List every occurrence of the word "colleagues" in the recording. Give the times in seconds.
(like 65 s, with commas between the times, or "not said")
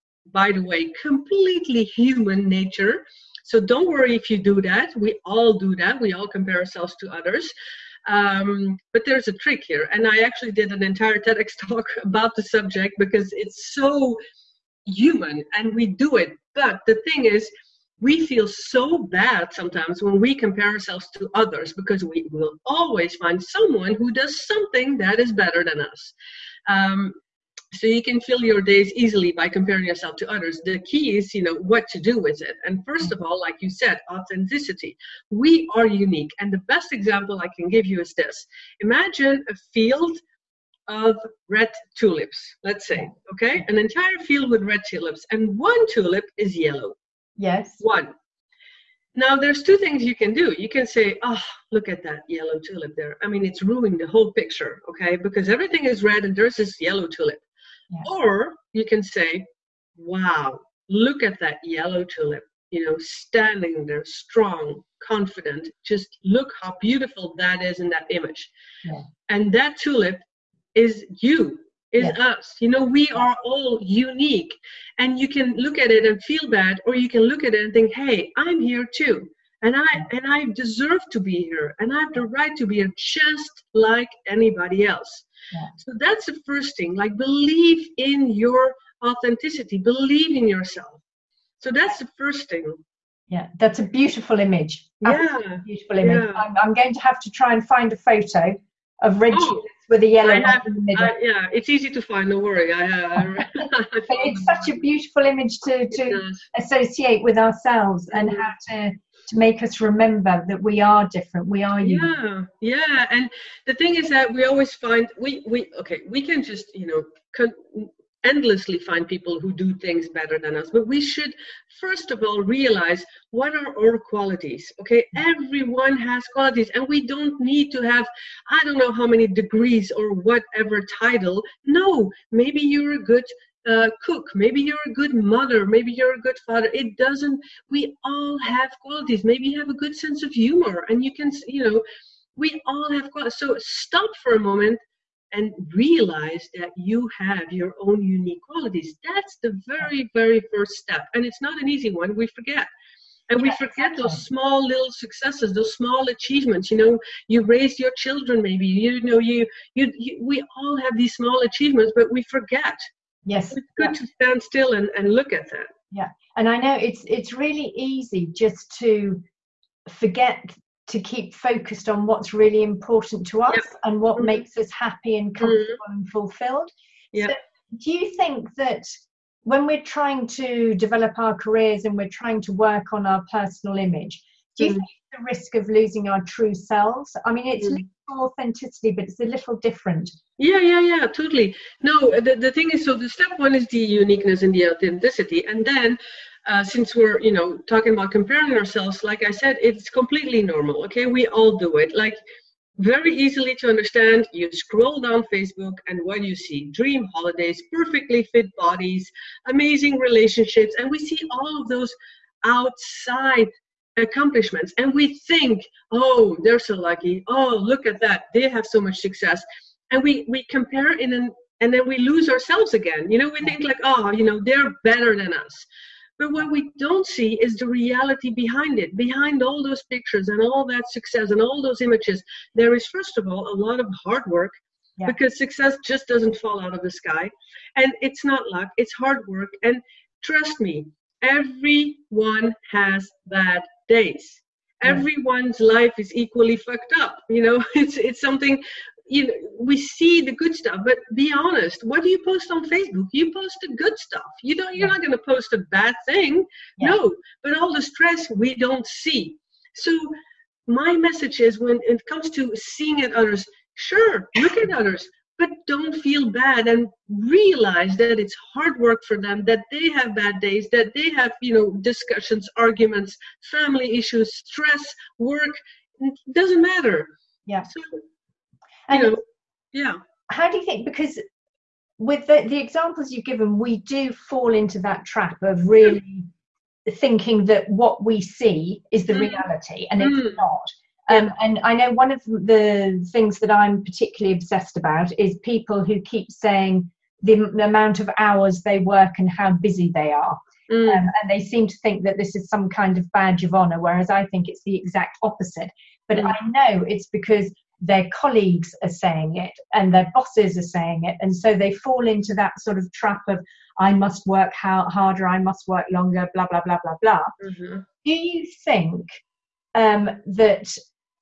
308 s.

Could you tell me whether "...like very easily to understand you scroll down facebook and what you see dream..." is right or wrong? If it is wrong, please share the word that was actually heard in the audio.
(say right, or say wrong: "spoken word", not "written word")
right.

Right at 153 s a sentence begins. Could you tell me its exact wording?
And we forget those small little successes, those small achievements.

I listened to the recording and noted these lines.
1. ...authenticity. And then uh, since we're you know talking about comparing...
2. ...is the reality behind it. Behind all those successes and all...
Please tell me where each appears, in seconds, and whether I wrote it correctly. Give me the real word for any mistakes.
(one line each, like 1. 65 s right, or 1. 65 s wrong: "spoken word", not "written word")
1. 194 s right
2. 227 s wrong: "pictures", not "successes".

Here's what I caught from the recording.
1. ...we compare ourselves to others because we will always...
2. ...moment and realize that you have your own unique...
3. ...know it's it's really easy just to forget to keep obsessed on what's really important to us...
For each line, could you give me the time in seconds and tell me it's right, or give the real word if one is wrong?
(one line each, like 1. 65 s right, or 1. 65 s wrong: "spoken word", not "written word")
1. 20 s right
2. 144 s right
3. 166 s wrong: "focused", not "obsessed".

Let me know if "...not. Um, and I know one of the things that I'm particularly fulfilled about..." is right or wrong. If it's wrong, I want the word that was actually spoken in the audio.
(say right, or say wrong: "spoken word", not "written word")
wrong: "obsessed", not "fulfilled".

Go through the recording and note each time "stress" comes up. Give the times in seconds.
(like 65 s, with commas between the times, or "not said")
257 s, 274 s.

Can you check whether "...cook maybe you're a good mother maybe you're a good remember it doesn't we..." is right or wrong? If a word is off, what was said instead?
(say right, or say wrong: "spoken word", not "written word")
wrong: "father", not "remember".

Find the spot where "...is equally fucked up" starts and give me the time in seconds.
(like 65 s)
245 s.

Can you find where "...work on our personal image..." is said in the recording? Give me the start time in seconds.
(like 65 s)
182 s.